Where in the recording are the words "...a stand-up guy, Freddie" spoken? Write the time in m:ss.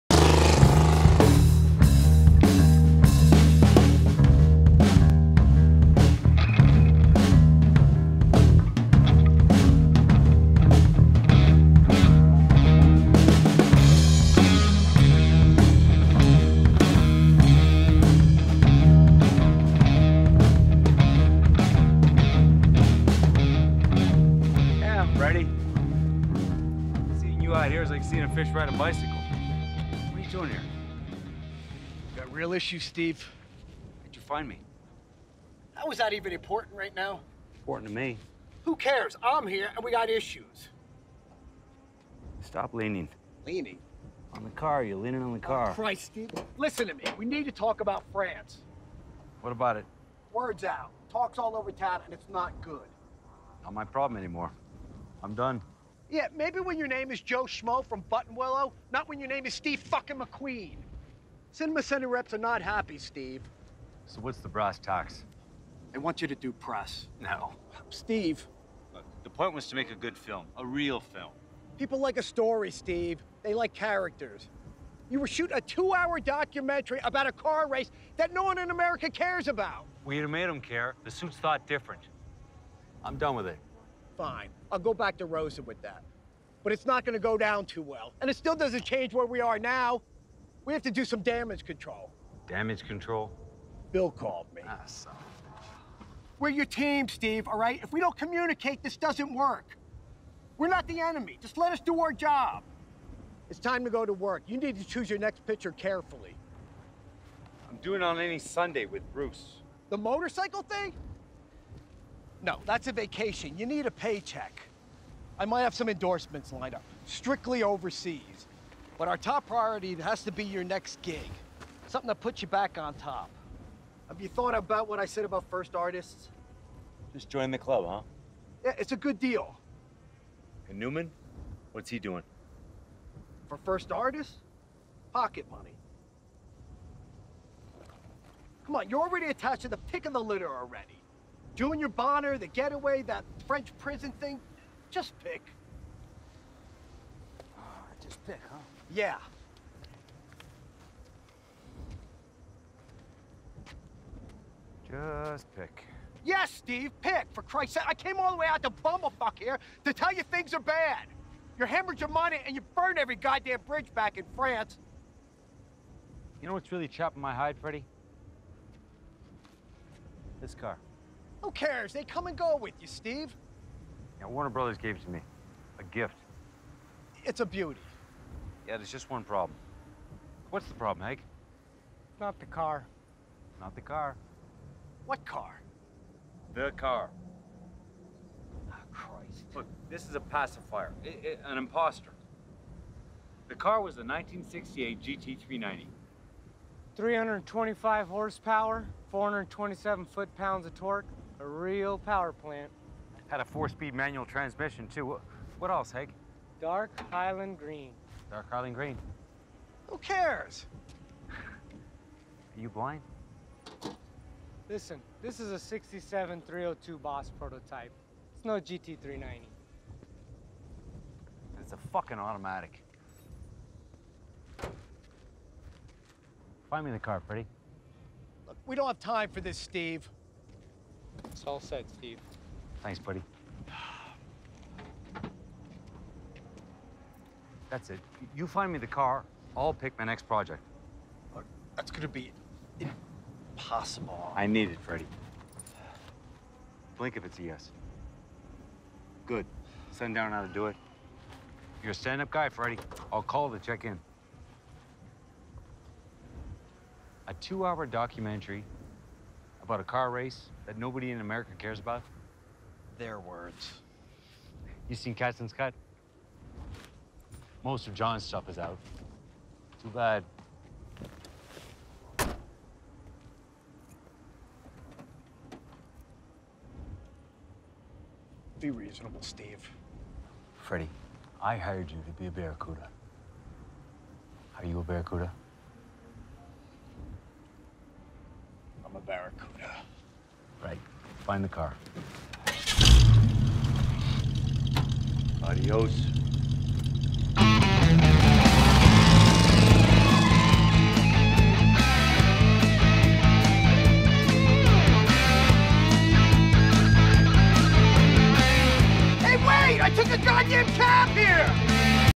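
4:11.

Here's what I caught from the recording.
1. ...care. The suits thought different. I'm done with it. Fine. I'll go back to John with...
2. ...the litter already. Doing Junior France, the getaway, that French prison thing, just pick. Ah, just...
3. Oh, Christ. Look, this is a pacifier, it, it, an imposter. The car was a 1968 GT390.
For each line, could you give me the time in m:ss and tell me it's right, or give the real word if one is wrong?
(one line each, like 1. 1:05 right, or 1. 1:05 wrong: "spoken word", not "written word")
1. 1:20 wrong: "Rosa", not "John"
2. 2:20 wrong: "Bonner", not "France"
3. 3:08 right.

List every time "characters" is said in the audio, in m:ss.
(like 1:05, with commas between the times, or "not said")
1:13.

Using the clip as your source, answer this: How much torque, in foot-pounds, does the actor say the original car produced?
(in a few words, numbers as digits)
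427.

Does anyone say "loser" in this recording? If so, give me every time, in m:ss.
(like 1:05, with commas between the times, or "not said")
not said.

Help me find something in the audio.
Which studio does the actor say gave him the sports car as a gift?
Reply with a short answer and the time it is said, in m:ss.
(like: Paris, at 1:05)
Warner Brothers, at 2:54.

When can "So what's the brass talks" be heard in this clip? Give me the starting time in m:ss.
1:04.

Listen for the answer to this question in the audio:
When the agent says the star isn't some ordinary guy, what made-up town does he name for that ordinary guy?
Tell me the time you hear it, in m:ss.
0:58.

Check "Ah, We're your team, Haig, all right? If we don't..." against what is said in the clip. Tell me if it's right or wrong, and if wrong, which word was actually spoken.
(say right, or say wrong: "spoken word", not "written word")
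wrong: "Steve", not "Haig".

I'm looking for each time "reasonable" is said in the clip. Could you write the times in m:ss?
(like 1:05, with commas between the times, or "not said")
4:38.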